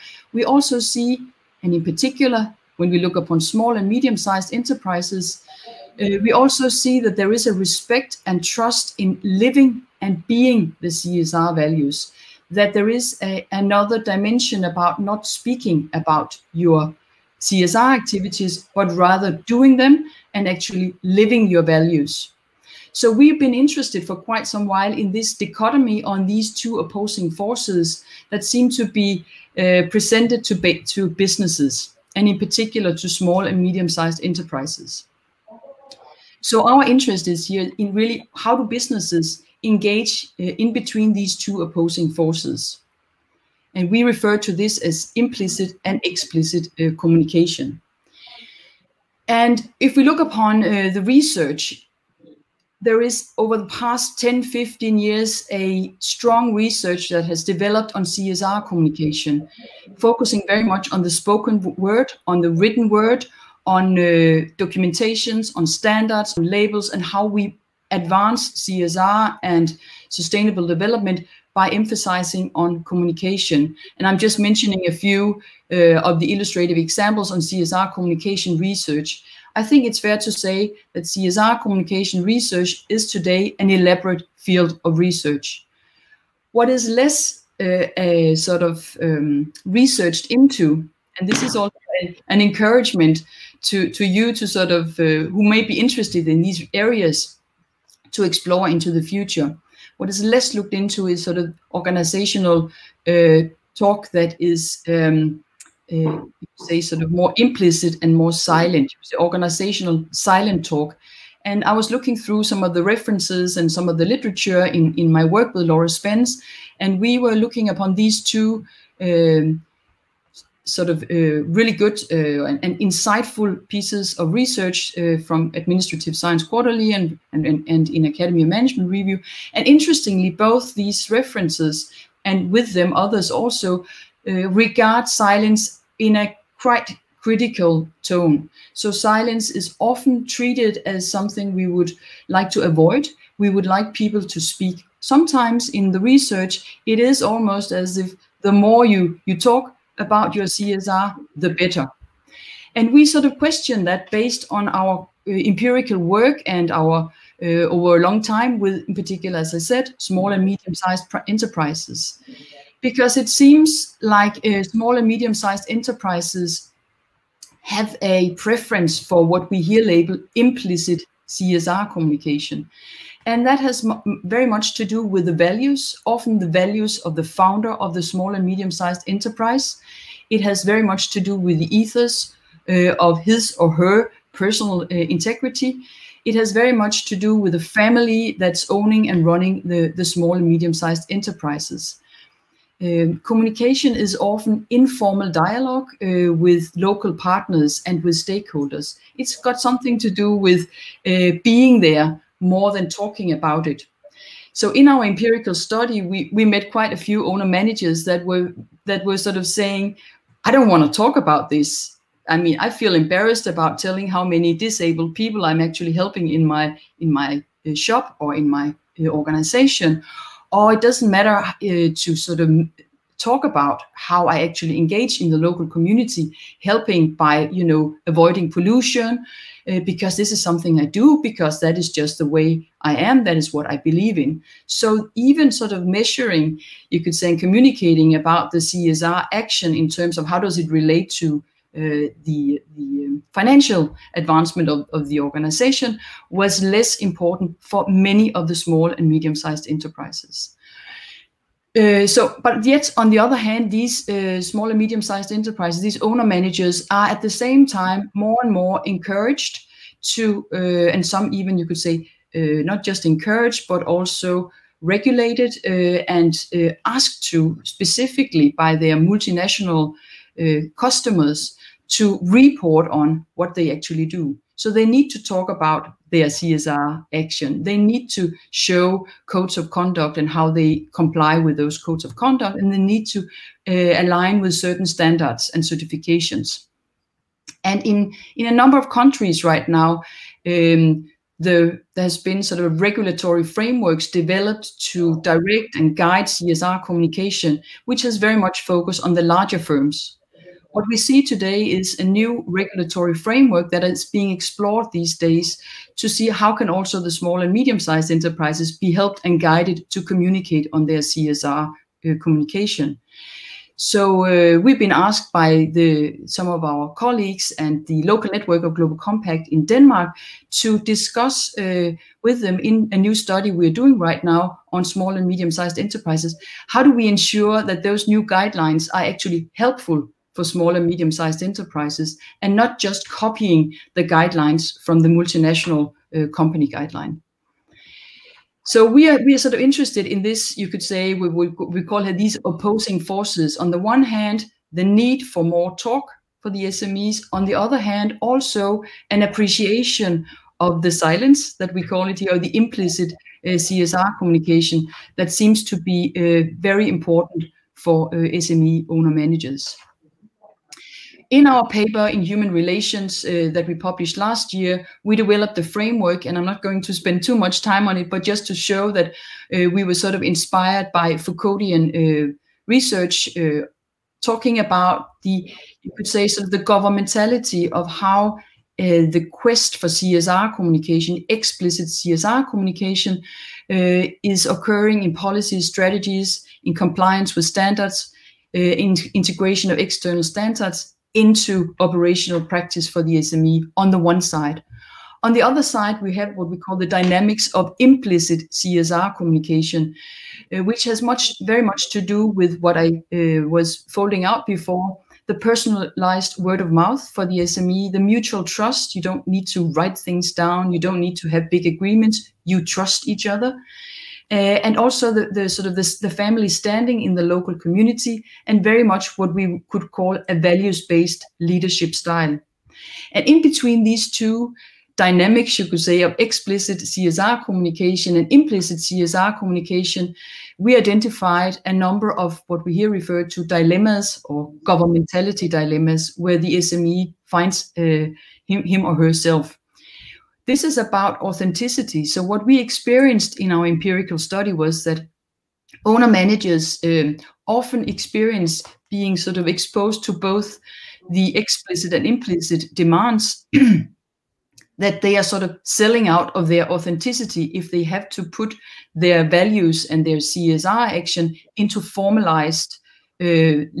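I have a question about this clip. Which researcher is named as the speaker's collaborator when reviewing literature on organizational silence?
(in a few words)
Laura Spence.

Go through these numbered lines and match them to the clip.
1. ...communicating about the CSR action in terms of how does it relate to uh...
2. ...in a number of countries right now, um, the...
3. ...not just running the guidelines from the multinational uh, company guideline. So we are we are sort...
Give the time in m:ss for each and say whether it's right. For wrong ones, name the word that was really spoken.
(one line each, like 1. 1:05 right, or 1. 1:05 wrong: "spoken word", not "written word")
1. 3:57 right
2. 4:48 right
3. 5:32 wrong: "copying", not "running".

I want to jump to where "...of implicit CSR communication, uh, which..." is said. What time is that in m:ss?
6:37.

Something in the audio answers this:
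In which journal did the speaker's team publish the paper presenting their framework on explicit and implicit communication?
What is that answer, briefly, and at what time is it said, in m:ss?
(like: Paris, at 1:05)
Human Relations, at 6:02.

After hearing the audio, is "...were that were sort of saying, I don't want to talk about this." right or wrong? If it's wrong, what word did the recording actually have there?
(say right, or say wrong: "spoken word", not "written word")
right.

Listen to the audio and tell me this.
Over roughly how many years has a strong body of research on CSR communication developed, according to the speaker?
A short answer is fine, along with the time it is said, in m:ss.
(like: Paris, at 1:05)
10 15 years, at 0:54.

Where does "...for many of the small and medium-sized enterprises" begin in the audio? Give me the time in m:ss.
4:07.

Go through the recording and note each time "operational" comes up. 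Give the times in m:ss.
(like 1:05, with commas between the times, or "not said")
6:31.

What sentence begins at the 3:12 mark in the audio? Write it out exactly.
Um, communication is often informal dialogue uh, with local partners and with stakeholders.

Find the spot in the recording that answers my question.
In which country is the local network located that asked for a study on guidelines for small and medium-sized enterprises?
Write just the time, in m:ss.
5:19.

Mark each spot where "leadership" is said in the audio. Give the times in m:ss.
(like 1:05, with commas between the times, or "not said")
7:01.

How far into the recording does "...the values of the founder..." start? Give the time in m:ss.
2:56.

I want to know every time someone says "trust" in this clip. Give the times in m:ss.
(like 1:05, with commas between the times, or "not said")
0:08, 6:48, 6:52.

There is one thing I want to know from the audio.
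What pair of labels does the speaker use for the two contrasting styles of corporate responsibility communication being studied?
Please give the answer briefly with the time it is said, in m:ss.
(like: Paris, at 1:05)
implicit and explicit, at 0:45.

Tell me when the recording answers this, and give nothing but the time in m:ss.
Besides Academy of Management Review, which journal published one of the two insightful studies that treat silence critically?
2:05.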